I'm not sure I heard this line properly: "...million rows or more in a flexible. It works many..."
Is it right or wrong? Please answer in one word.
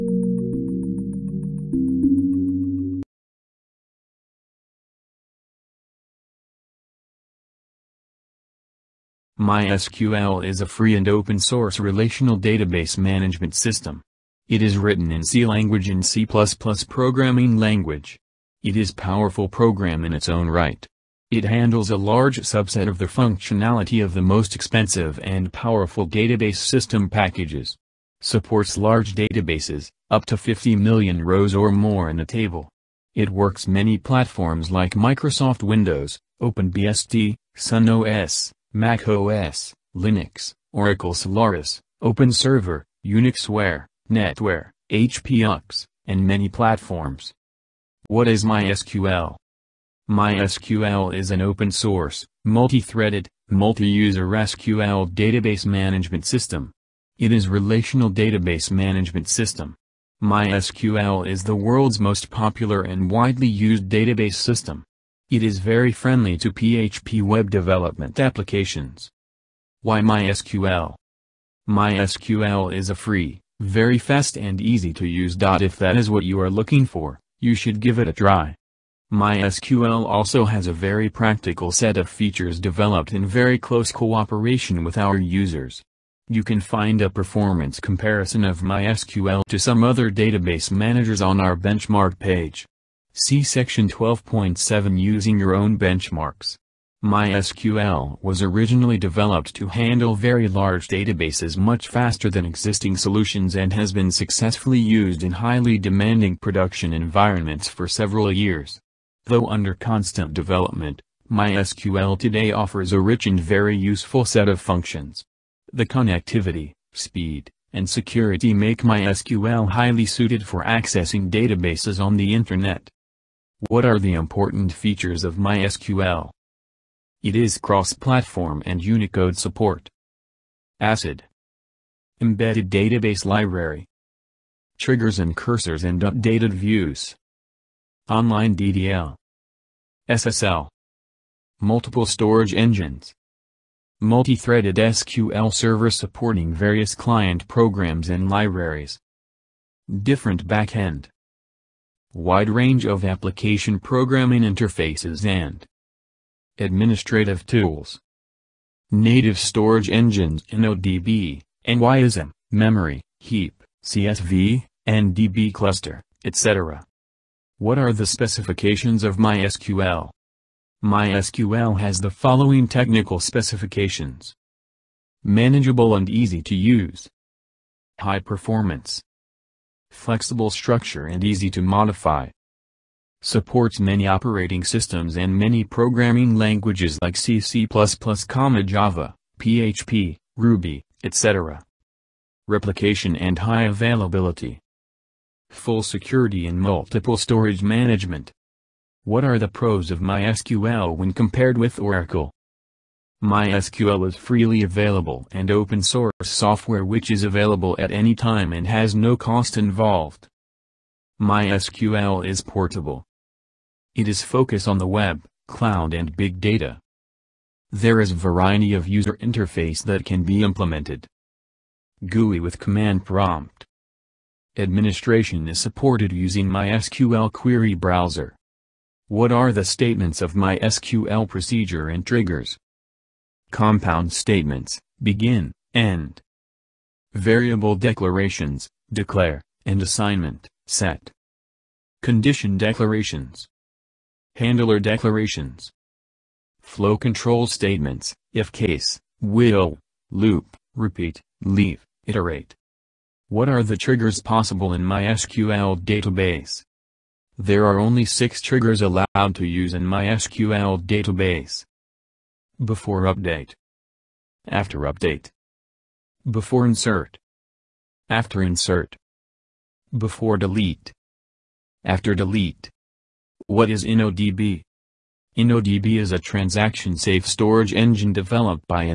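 wrong.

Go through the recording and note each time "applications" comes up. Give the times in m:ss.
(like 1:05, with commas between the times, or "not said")
1:08, 2:33.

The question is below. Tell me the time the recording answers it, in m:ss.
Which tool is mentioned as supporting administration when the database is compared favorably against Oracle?
3:46.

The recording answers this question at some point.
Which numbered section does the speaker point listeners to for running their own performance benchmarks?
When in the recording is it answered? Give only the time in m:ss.
1:33.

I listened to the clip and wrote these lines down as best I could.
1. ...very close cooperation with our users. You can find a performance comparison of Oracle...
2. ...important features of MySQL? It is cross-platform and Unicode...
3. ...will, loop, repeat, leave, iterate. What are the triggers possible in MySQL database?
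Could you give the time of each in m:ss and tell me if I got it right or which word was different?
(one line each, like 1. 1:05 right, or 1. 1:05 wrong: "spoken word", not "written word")
1. 1:23 wrong: "MySQL", not "Oracle"
2. 2:04 right
3. 4:09 right.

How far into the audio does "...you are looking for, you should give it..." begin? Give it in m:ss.
1:16.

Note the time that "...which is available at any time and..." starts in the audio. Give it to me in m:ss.
3:26.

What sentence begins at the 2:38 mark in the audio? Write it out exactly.
Native storage engines in ODB, MyISAM, memory, heap, CSV, and DB cluster, etc.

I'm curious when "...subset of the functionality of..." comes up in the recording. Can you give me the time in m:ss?
0:22.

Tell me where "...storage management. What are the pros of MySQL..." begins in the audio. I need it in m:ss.
3:17.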